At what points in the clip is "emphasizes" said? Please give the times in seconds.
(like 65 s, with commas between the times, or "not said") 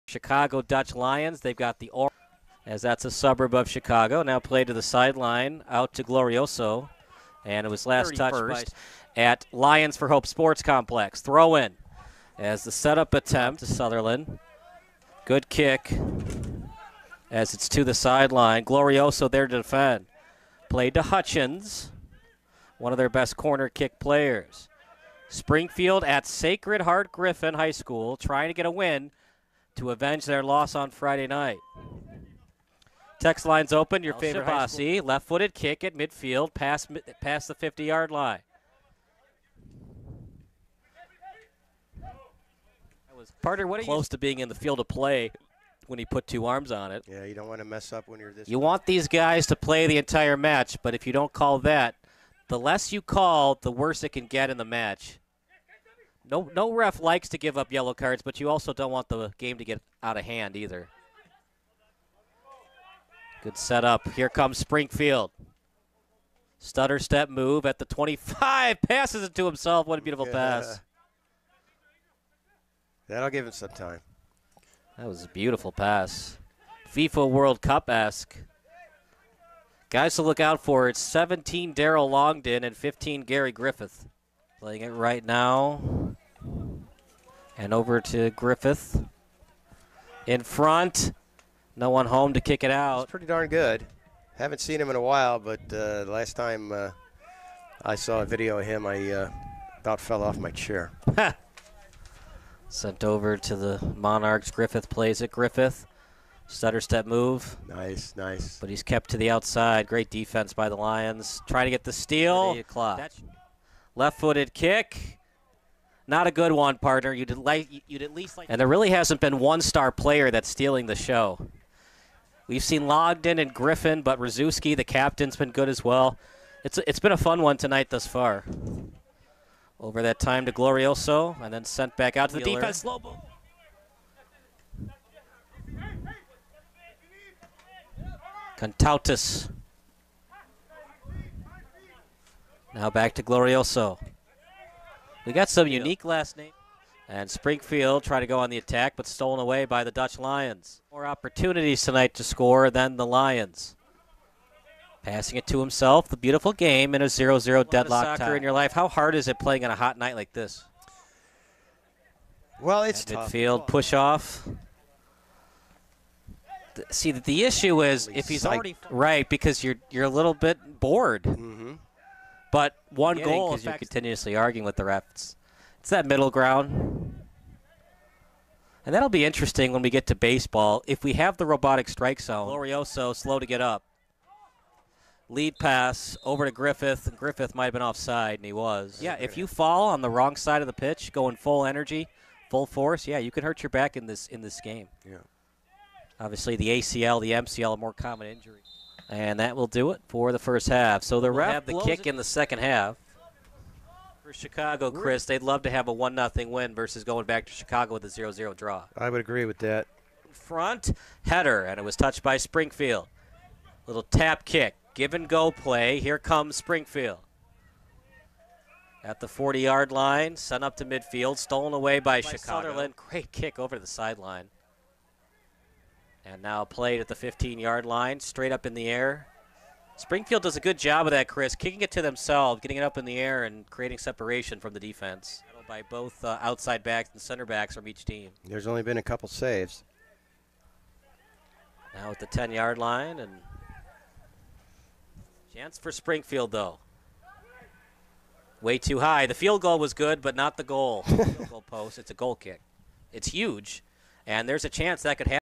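not said.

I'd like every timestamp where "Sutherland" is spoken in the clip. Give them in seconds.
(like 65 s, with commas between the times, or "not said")
13 s, 222 s.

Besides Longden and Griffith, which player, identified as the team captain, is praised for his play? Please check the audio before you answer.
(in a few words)
Rzuski.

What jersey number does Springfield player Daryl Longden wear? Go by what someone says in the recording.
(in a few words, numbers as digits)
17.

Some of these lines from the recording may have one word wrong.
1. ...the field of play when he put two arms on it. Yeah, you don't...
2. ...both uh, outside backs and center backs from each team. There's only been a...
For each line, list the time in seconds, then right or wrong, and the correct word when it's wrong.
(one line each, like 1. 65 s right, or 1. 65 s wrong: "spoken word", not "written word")
1. 44 s right
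2. 235 s right.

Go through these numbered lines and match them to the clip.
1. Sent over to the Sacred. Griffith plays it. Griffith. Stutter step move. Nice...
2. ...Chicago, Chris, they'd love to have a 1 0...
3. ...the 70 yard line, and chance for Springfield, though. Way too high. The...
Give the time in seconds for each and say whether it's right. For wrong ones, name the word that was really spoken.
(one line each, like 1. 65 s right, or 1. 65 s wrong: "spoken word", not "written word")
1. 102 s wrong: "Monarchs", not "Sacred"
2. 204 s right
3. 242 s wrong: "10", not "70".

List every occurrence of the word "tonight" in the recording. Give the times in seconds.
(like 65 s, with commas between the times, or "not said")
127 s, 151 s.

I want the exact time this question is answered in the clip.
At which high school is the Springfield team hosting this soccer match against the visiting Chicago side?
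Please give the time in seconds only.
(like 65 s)
26 s.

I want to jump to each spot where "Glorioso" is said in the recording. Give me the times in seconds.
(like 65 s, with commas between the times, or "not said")
6 s, 18 s, 130 s, 143 s, 182 s.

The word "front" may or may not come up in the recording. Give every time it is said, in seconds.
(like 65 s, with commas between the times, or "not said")
90 s, 210 s.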